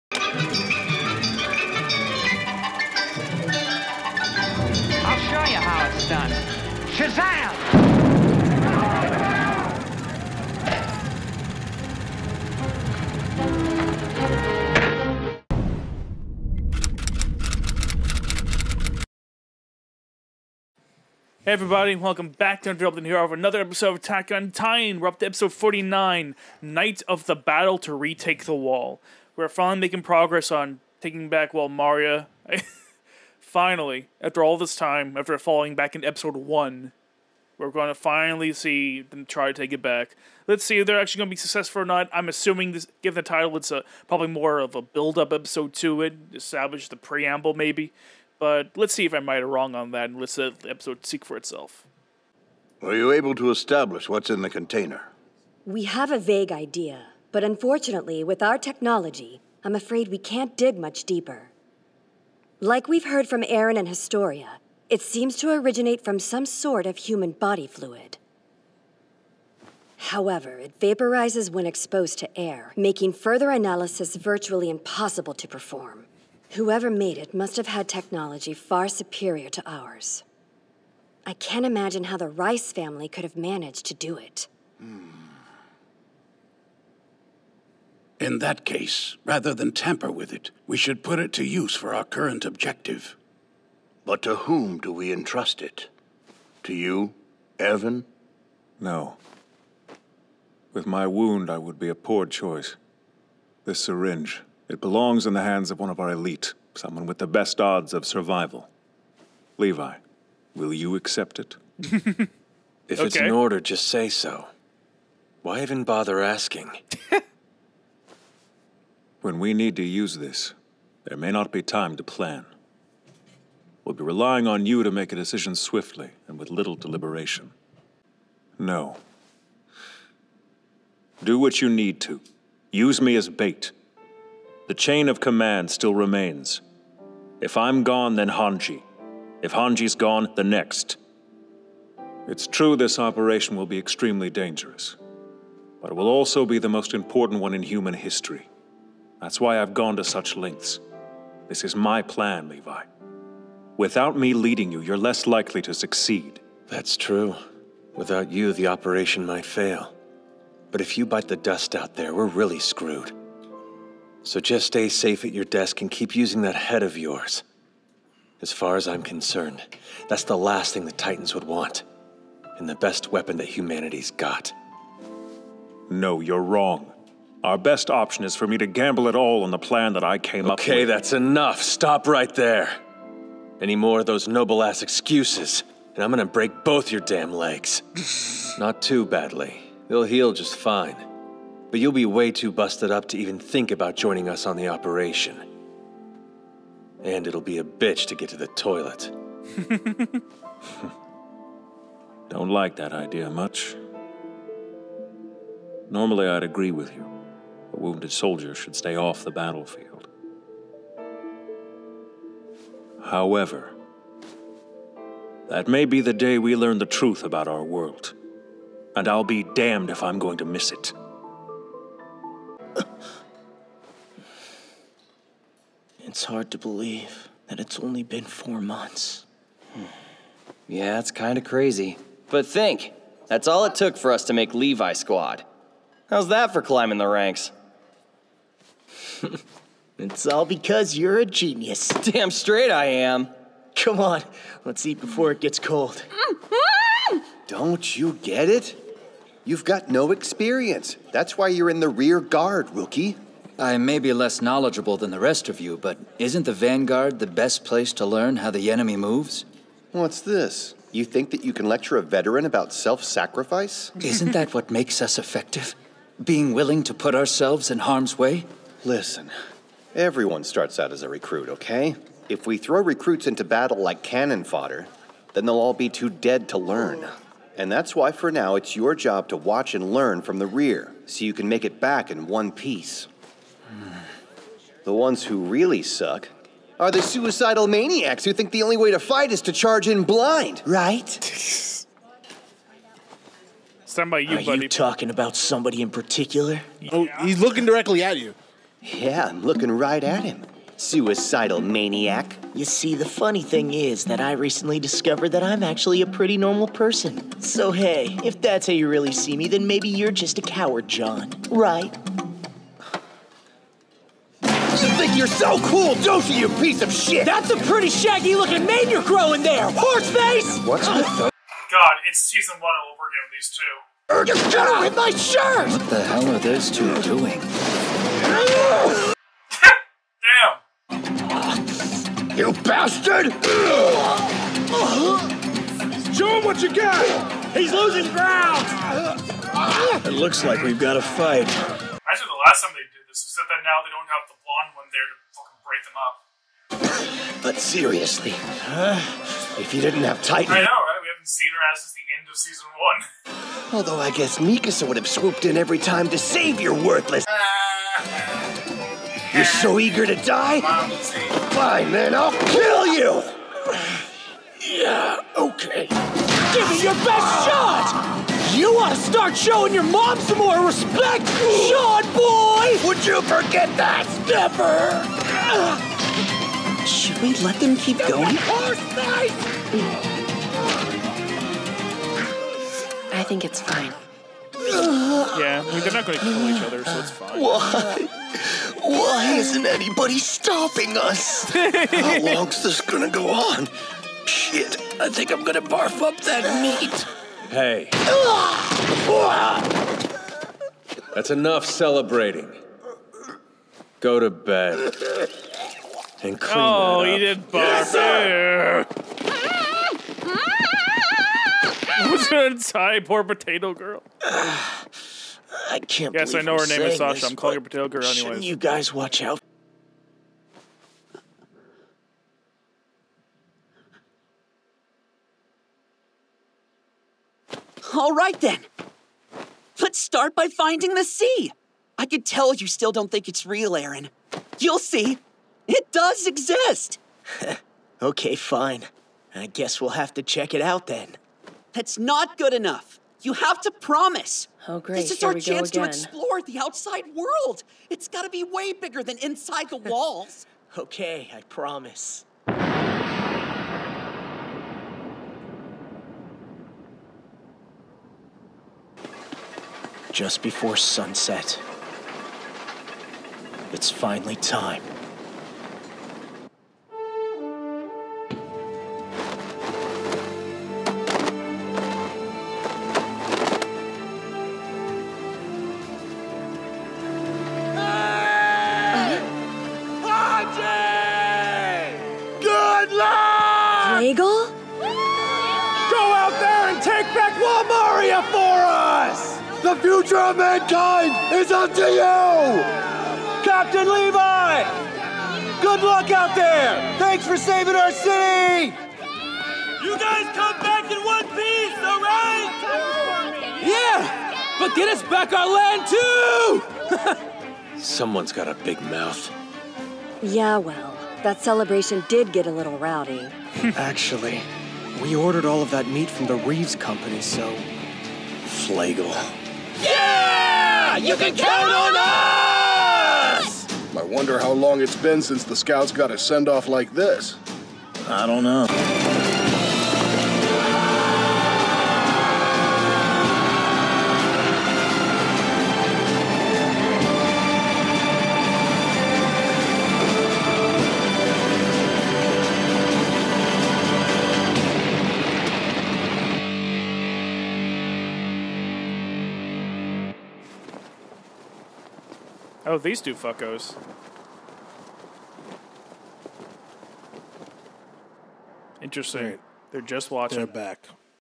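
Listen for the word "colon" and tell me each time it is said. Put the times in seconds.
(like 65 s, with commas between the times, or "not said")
not said.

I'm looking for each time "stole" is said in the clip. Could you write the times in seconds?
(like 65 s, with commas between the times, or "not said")
not said.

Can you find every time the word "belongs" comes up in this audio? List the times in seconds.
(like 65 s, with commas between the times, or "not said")
104 s.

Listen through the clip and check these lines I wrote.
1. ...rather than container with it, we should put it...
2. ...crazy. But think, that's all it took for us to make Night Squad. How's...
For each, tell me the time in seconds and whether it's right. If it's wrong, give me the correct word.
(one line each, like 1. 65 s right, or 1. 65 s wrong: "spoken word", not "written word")
1. 89 s wrong: "tamper", not "container"
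2. 231 s wrong: "Levi", not "Night".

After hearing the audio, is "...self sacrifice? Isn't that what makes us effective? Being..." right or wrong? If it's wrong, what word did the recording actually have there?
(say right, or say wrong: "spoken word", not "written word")
right.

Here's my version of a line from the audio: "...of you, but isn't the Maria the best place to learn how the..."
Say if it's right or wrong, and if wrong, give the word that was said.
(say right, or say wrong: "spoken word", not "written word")
wrong: "Vanguard", not "Maria".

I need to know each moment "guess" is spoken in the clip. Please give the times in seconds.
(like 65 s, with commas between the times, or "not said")
354 s, 439 s.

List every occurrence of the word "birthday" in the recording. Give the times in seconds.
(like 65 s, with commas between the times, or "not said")
not said.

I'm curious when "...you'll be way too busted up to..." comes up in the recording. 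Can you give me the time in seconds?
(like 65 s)
191 s.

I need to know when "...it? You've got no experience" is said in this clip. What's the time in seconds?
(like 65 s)
248 s.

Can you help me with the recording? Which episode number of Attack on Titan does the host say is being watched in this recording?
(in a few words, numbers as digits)
49.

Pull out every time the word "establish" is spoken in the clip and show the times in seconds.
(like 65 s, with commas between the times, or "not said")
46 s, 53 s.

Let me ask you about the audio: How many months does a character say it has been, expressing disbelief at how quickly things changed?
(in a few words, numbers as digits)
four months.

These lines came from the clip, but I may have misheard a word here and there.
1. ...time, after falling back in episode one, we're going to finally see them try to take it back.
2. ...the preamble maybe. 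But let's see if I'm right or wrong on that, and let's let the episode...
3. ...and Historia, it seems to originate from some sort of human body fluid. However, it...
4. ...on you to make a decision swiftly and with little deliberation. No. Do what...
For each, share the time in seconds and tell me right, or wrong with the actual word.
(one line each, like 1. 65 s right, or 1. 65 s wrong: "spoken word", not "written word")
1. 34 s right
2. 46 s right
3. 63 s right
4. 124 s right.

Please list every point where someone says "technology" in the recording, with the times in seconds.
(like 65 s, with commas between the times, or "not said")
58 s, 77 s.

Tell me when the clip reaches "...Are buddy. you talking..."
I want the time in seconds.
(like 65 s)
294 s.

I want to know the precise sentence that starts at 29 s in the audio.
We're finally making progress on taking back Maria.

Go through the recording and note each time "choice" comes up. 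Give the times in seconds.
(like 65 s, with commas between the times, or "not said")
102 s.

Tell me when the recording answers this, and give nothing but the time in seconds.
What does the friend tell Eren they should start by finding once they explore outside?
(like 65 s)
430 s.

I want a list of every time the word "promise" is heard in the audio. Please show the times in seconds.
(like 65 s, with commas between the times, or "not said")
443 s, 451 s.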